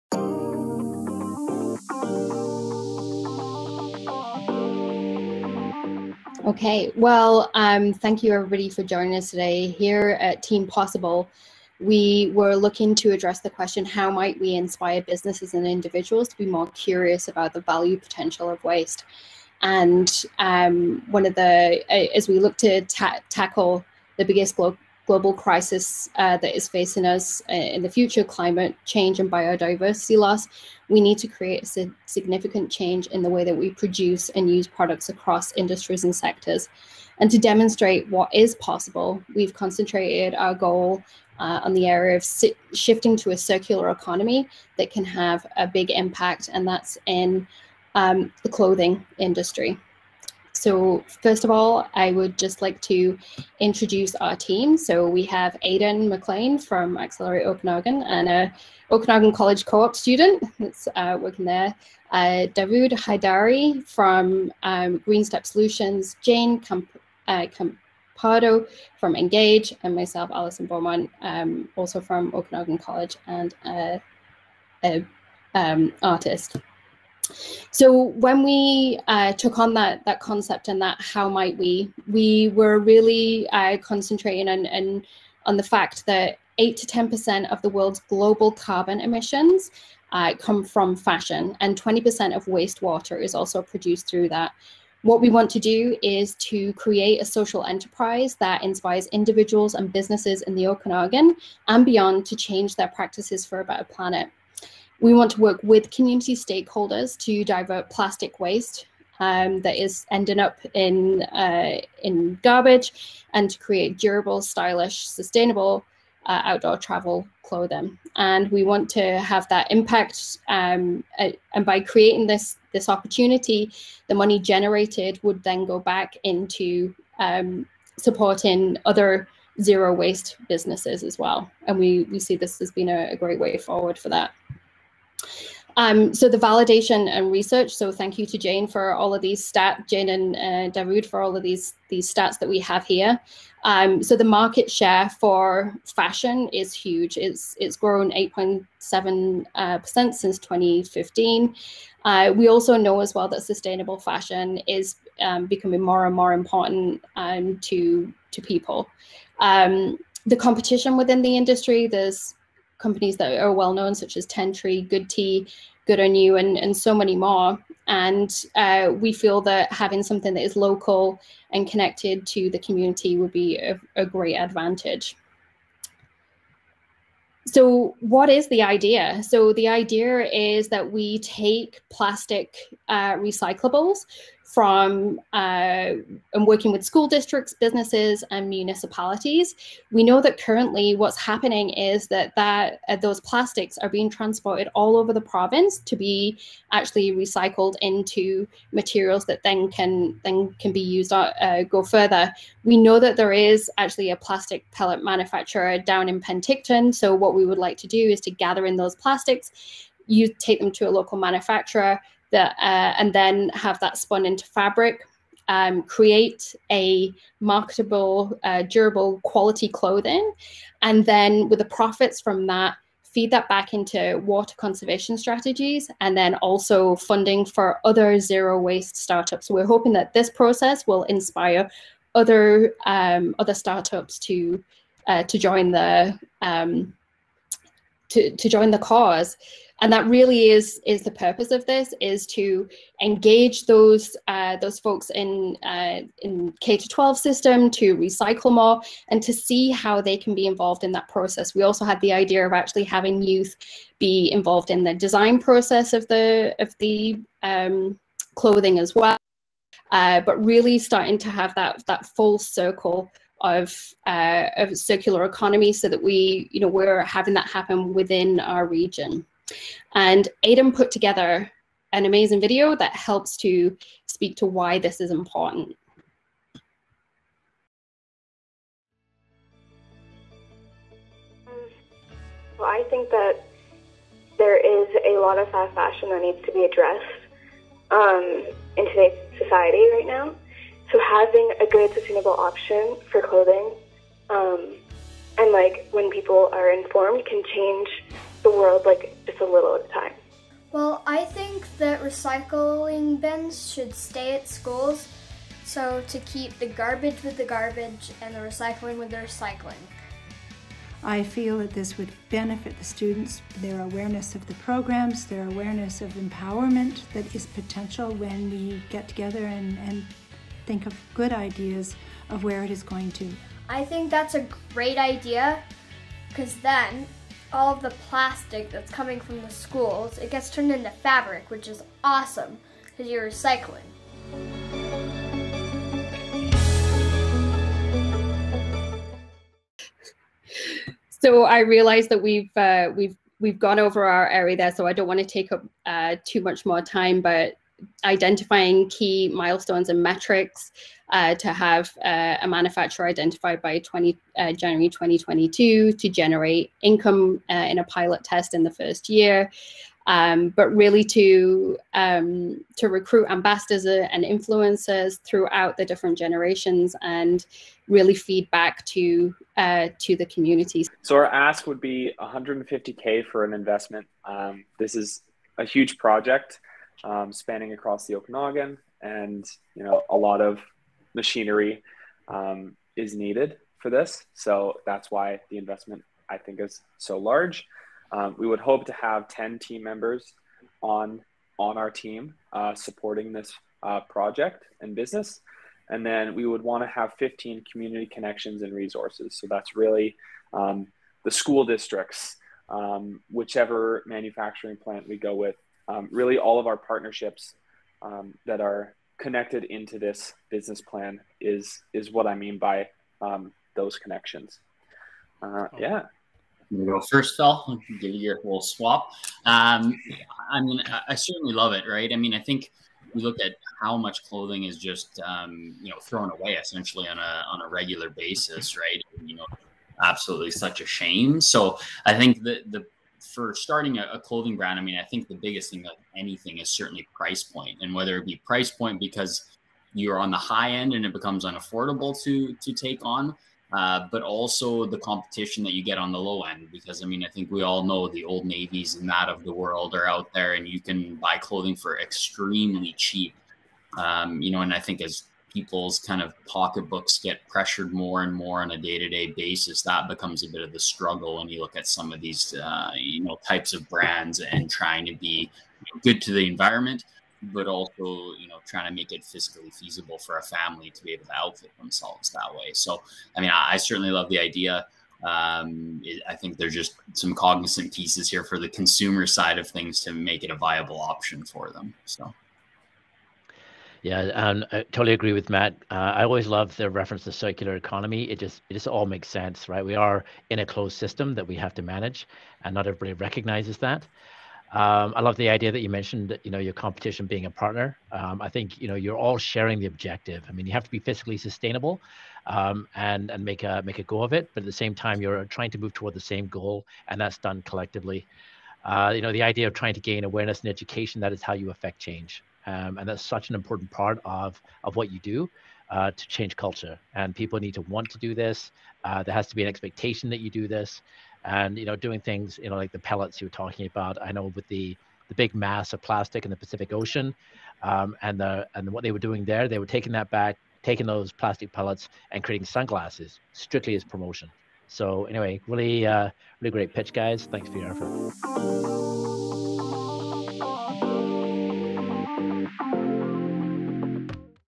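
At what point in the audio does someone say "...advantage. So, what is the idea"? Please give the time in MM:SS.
02:54.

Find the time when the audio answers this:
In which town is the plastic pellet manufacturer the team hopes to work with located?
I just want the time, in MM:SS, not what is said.
03:26.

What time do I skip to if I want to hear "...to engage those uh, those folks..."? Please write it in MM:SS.
04:02.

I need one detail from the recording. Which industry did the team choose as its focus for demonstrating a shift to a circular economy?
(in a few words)
clothing industry.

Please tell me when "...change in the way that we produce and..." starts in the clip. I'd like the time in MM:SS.
00:32.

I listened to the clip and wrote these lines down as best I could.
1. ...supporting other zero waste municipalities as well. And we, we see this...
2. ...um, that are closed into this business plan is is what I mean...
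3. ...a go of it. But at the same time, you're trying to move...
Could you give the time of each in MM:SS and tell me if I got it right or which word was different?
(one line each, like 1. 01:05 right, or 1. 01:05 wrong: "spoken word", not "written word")
1. 02:07 wrong: "businesses", not "municipalities"
2. 06:48 wrong: "connected", not "closed"
3. 08:23 right.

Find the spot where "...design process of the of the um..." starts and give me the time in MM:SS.
04:14.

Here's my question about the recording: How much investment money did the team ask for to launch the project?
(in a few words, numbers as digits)
150k.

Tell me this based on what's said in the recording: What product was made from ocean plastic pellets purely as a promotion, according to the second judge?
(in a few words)
sunglasses.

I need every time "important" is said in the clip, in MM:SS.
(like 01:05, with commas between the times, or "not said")
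02:36, 04:35, 08:33.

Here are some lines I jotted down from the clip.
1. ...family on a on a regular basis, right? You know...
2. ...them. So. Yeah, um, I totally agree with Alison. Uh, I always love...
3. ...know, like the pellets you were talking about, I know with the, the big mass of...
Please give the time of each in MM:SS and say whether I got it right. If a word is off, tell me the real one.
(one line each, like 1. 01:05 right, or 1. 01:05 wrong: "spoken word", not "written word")
1. 07:06 wrong: "essentially", not "family"
2. 08:01 wrong: "Matt", not "Alison"
3. 08:42 right.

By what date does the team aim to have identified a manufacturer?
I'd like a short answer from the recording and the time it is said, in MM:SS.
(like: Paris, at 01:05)
January 2022, at 05:54.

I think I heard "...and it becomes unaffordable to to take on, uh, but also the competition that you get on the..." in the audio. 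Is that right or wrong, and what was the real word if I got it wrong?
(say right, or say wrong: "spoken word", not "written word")
right.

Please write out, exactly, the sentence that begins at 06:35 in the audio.
And then we would want to have 15 community connections and resources.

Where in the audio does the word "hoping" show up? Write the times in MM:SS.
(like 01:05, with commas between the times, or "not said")
03:49.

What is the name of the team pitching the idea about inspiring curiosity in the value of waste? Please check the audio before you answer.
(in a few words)
Team Possible.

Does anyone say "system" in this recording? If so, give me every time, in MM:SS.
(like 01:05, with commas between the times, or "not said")
04:07, 08:10.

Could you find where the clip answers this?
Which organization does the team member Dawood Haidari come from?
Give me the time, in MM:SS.
01:04.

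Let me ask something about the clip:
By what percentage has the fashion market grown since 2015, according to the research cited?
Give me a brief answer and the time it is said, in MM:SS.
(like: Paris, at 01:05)
8.7 percent, at 02:28.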